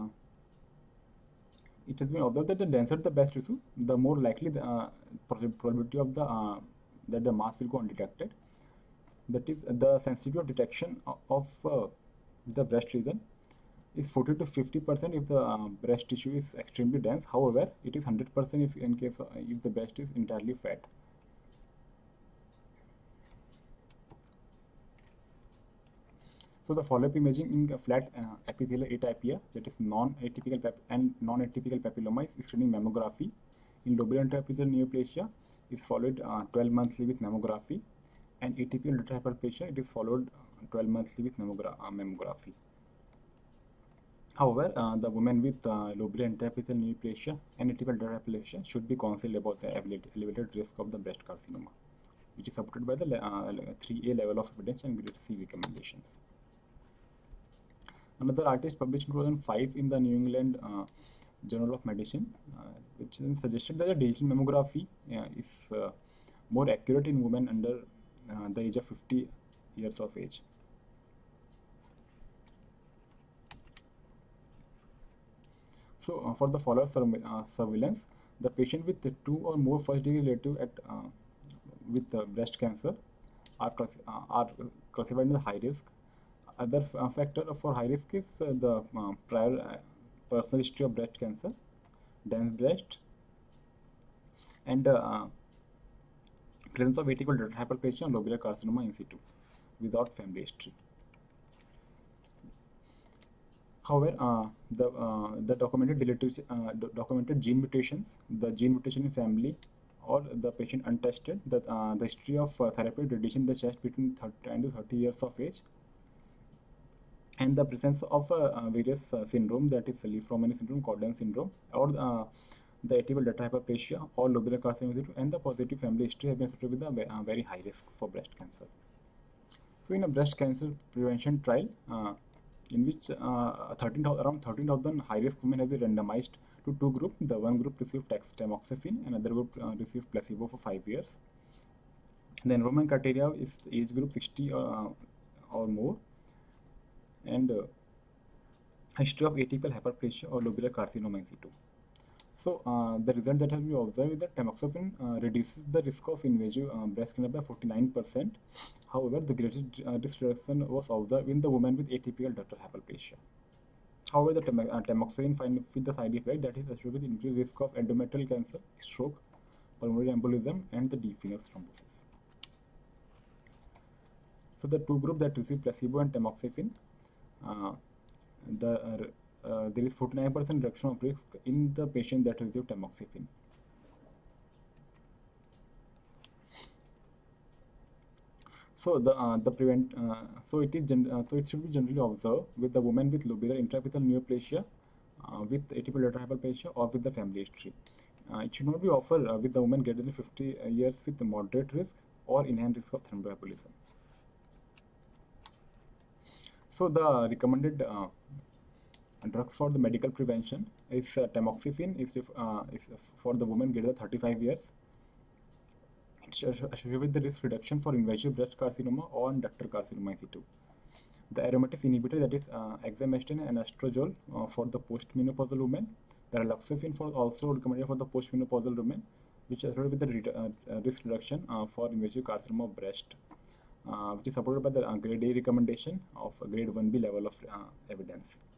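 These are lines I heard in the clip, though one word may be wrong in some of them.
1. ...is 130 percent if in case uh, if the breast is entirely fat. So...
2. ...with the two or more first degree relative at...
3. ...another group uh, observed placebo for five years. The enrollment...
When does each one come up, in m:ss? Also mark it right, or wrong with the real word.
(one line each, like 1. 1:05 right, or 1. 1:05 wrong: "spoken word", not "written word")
1. 0:17 wrong: "100", not "130"
2. 1:18 right
3. 2:19 wrong: "received", not "observed".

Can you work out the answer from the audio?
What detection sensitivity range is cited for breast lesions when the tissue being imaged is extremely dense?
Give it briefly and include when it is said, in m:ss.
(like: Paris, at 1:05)
40 to 50 percent, at 0:14.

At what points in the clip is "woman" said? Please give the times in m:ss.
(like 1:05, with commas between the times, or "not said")
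3:12, 3:19, 3:33.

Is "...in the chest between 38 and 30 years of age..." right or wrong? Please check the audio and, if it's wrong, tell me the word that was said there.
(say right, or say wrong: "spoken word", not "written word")
wrong: "30", not "38".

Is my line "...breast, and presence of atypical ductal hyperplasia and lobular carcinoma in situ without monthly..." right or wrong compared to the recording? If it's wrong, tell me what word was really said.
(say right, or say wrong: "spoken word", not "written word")
wrong: "family", not "monthly".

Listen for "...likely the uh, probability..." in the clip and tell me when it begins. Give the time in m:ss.
0:04.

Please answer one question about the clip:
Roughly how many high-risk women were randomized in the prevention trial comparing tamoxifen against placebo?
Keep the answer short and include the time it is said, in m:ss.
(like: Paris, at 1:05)
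13,000, at 2:14.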